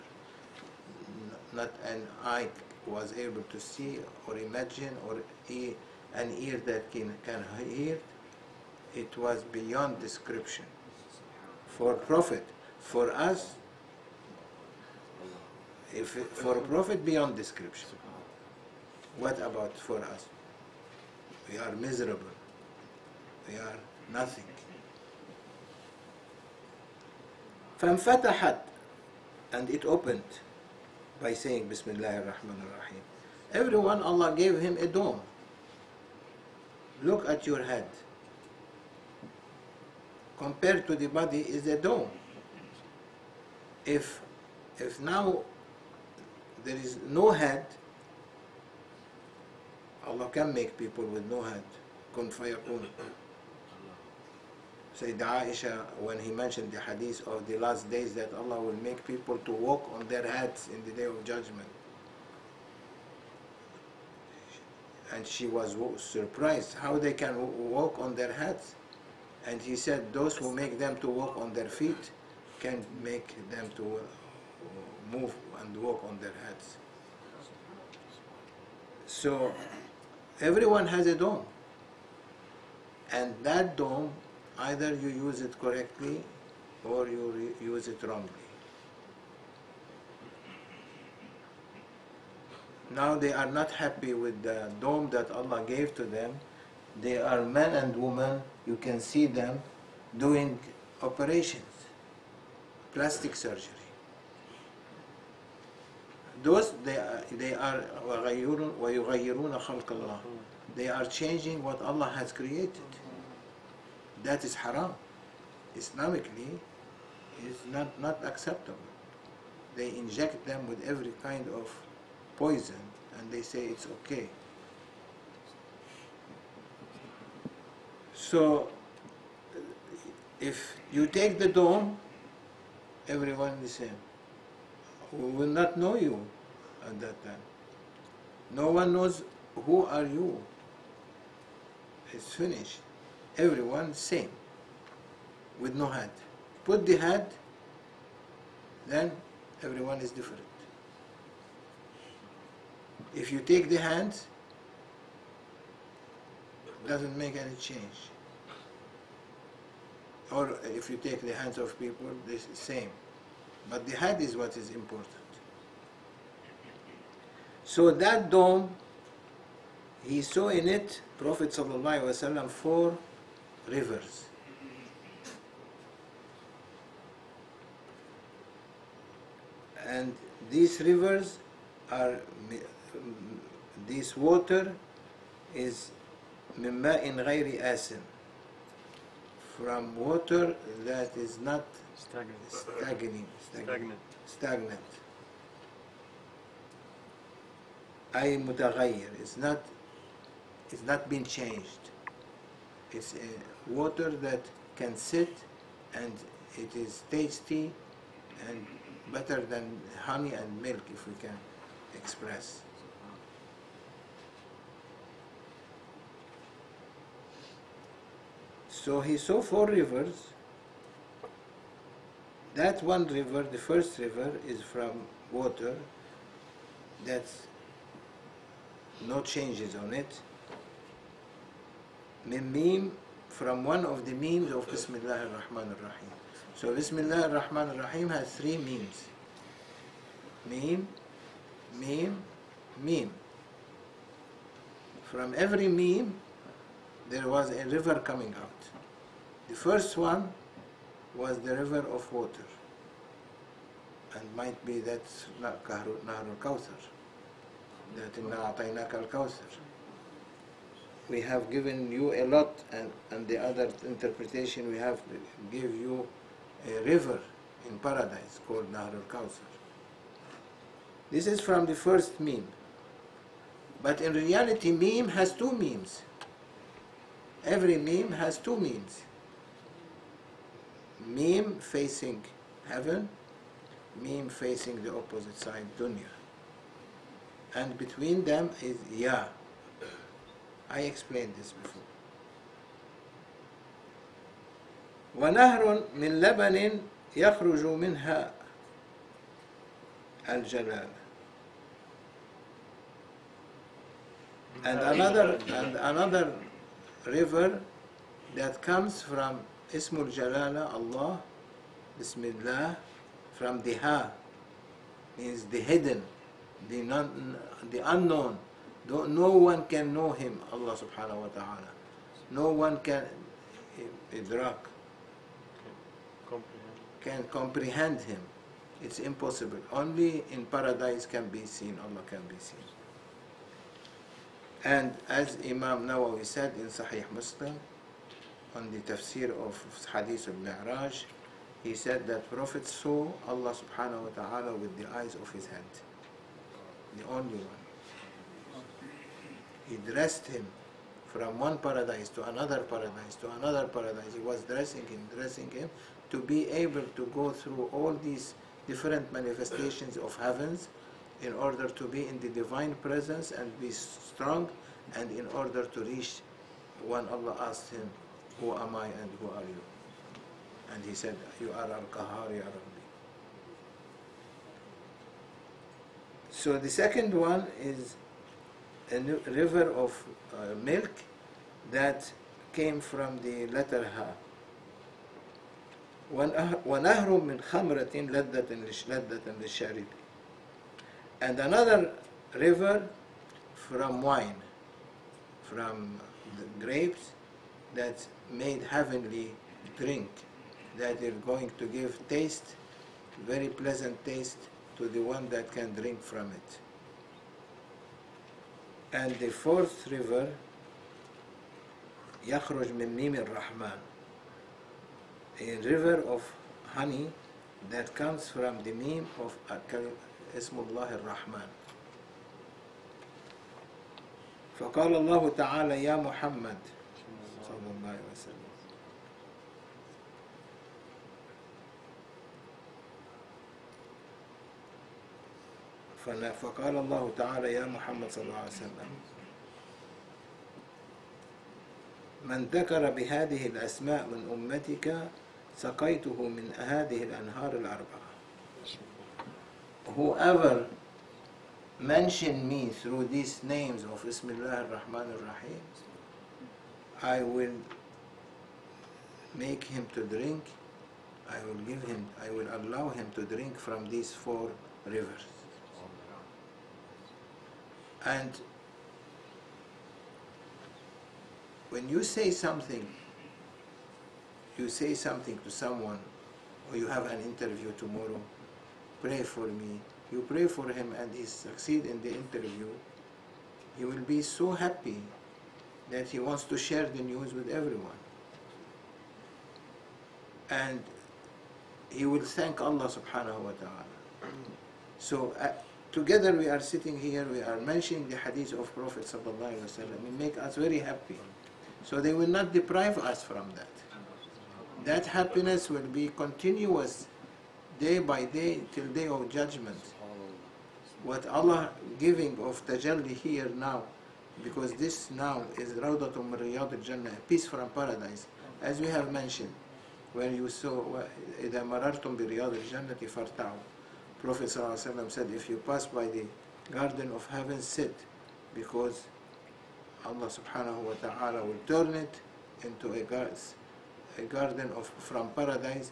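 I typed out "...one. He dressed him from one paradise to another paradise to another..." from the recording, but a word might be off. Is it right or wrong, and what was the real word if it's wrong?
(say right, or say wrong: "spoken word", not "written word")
right.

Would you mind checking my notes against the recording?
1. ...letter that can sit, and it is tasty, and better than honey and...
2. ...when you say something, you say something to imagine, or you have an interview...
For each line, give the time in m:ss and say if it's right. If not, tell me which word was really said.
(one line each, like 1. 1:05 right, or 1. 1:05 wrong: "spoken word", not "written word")
1. 3:23 wrong: "water", not "letter"
2. 7:51 wrong: "someone", not "imagine".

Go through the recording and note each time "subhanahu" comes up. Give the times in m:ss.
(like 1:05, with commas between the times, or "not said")
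5:20, 5:43, 8:12, 8:50.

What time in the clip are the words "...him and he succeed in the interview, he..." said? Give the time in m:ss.
8:00.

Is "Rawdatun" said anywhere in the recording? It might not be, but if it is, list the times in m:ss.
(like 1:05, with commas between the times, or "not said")
8:35.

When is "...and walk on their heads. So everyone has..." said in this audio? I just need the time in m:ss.
1:15.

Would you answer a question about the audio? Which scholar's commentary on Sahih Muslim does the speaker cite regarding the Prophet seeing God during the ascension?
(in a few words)
Imam Nawawi.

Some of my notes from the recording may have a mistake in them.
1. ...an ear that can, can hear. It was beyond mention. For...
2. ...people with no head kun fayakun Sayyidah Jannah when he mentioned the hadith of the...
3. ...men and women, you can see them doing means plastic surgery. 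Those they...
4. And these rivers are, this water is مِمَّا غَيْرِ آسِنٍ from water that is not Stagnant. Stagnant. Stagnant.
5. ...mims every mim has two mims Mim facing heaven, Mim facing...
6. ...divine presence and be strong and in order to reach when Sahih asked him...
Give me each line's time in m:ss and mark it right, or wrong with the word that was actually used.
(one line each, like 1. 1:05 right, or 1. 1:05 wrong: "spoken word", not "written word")
1. 0:06 wrong: "description", not "mention"
2. 0:50 wrong: "Aisha", not "Jannah"
3. 1:37 wrong: "operations", not "means"
4. 2:59 right
5. 4:35 right
6. 6:02 wrong: "Allah", not "Sahih".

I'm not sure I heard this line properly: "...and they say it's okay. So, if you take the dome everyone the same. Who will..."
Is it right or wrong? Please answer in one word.
right.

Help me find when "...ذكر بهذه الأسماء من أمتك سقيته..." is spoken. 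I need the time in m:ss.
7:22.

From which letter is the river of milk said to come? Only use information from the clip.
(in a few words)
Ha.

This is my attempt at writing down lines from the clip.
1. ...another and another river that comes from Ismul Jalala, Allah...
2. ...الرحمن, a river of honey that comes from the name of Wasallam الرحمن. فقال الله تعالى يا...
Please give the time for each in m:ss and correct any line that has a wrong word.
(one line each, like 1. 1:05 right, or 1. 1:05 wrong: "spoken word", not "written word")
1. 5:04 right
2. 6:53 wrong: "Ismullah", not "Wasallam".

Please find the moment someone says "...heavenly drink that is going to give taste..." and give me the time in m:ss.
6:38.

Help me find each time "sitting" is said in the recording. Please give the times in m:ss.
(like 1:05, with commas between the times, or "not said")
8:16.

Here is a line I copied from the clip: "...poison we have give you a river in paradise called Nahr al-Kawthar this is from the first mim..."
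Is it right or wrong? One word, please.
wrong.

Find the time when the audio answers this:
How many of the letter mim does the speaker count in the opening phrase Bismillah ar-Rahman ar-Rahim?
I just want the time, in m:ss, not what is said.
3:58.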